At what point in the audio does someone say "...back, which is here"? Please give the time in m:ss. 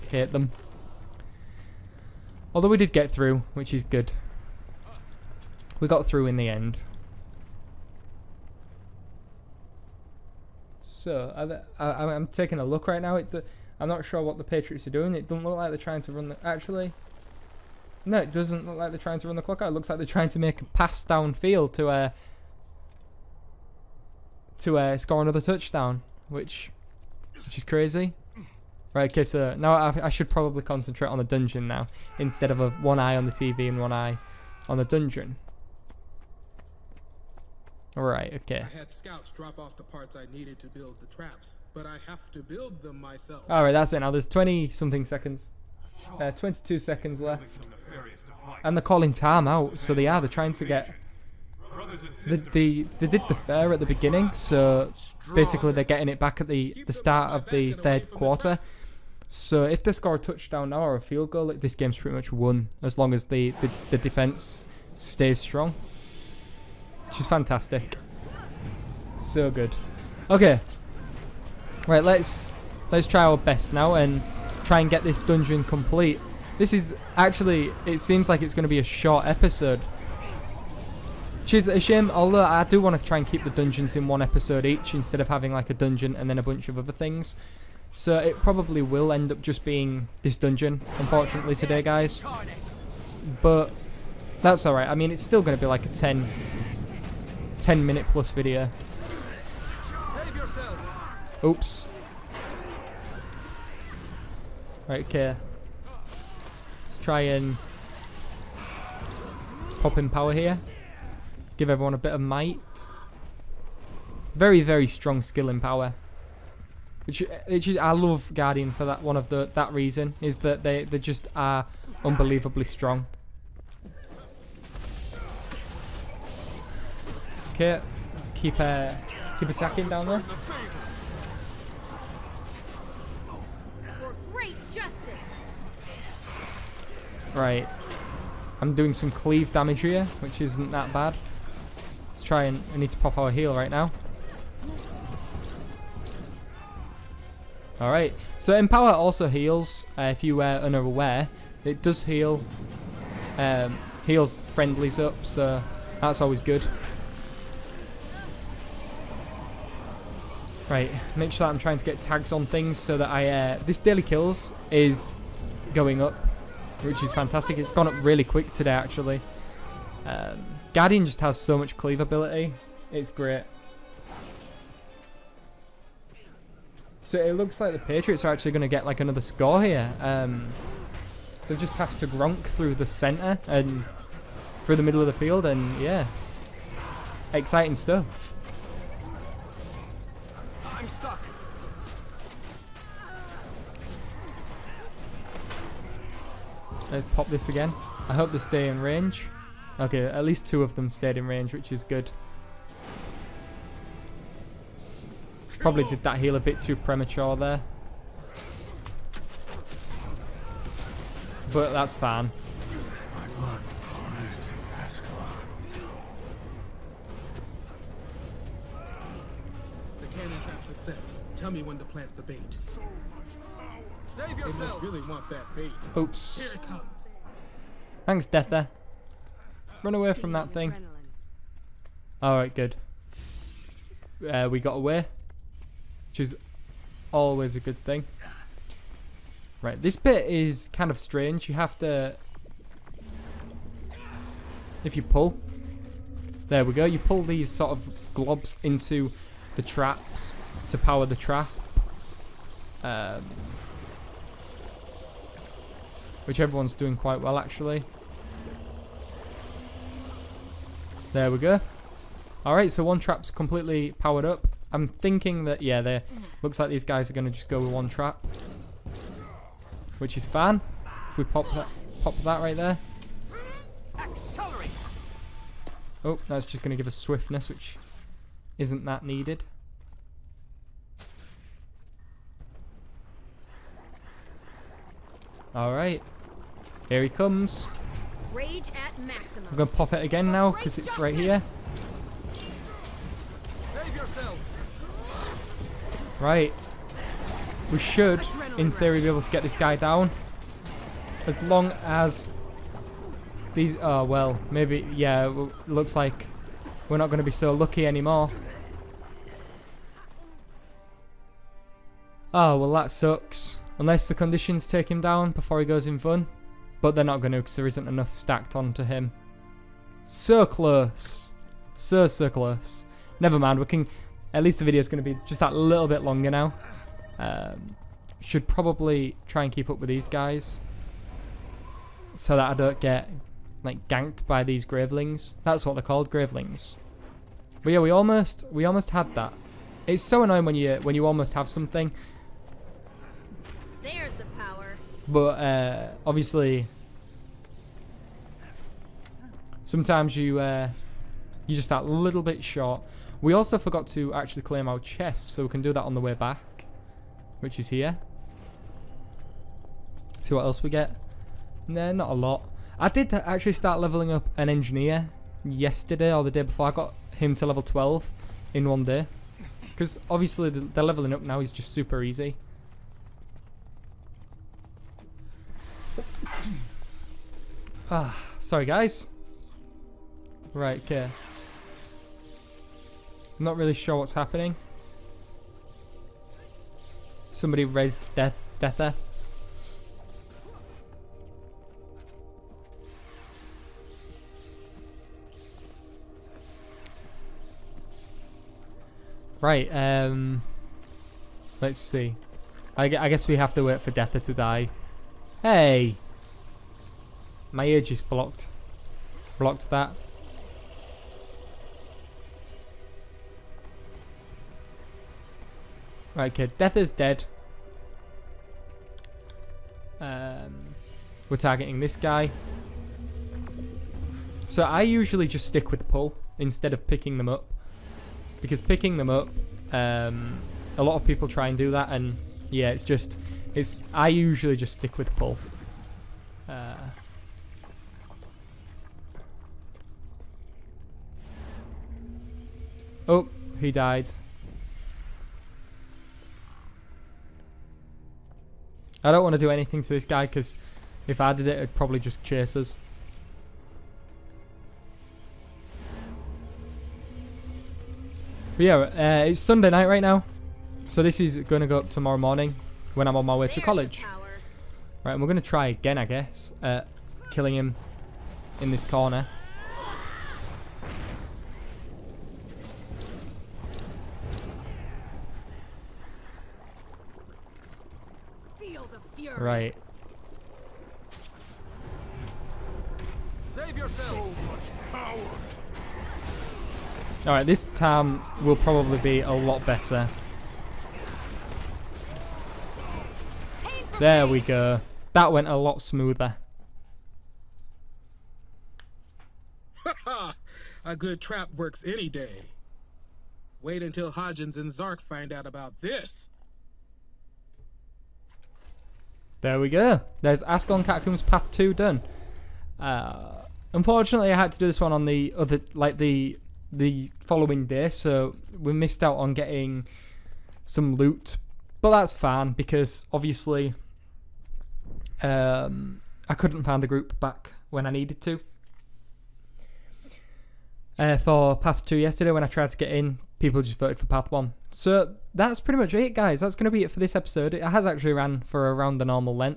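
5:56.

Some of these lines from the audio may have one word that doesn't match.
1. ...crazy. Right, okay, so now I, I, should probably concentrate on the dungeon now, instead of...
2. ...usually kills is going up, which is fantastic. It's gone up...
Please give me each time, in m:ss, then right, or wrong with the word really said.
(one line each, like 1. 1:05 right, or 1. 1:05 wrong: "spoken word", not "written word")
1. 0:27 right
2. 2:43 wrong: "daily", not "usually".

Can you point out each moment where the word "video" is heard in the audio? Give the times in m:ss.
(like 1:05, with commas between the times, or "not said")
1:38, 5:24.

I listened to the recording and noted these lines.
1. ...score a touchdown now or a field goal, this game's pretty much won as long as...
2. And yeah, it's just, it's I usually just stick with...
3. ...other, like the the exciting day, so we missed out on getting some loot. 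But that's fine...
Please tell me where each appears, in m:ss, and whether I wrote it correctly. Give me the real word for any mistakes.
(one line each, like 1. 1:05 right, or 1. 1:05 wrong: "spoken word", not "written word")
1. 0:59 right
2. 7:11 right
3. 8:35 wrong: "following", not "exciting".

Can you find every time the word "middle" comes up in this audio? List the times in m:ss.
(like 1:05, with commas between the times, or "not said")
3:04.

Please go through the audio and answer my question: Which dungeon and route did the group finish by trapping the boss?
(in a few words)
Ascalon Catacombs Path 2.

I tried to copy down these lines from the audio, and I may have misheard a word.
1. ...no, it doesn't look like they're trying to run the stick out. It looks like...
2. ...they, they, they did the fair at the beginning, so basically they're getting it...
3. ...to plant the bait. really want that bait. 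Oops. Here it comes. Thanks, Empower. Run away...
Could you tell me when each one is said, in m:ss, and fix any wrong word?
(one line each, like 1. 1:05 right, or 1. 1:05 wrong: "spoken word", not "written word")
1. 0:18 wrong: "clock", not "stick"
2. 0:52 right
3. 3:41 wrong: "Detha", not "Empower".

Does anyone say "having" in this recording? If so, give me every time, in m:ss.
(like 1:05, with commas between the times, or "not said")
1:25.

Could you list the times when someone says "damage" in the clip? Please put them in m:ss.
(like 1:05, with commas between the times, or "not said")
2:19.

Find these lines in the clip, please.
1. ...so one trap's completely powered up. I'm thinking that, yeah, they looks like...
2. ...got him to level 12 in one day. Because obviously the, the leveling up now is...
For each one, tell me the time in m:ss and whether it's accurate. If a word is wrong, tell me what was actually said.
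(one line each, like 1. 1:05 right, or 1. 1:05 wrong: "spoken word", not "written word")
1. 4:22 right
2. 6:06 right.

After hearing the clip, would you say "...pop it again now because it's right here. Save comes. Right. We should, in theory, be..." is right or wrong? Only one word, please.
wrong.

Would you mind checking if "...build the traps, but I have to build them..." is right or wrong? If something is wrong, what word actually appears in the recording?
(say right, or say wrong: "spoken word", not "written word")
right.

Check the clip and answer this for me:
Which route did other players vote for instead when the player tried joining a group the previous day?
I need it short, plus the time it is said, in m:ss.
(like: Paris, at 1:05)
Path 1, at 8:54.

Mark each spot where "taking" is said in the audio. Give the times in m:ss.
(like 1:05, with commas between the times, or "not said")
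0:12.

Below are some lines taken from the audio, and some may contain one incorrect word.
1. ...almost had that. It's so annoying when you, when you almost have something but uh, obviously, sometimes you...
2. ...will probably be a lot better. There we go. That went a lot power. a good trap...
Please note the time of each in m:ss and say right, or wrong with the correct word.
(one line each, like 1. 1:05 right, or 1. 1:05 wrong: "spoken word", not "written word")
1. 5:38 right
2. 8:08 wrong: "smoother", not "power".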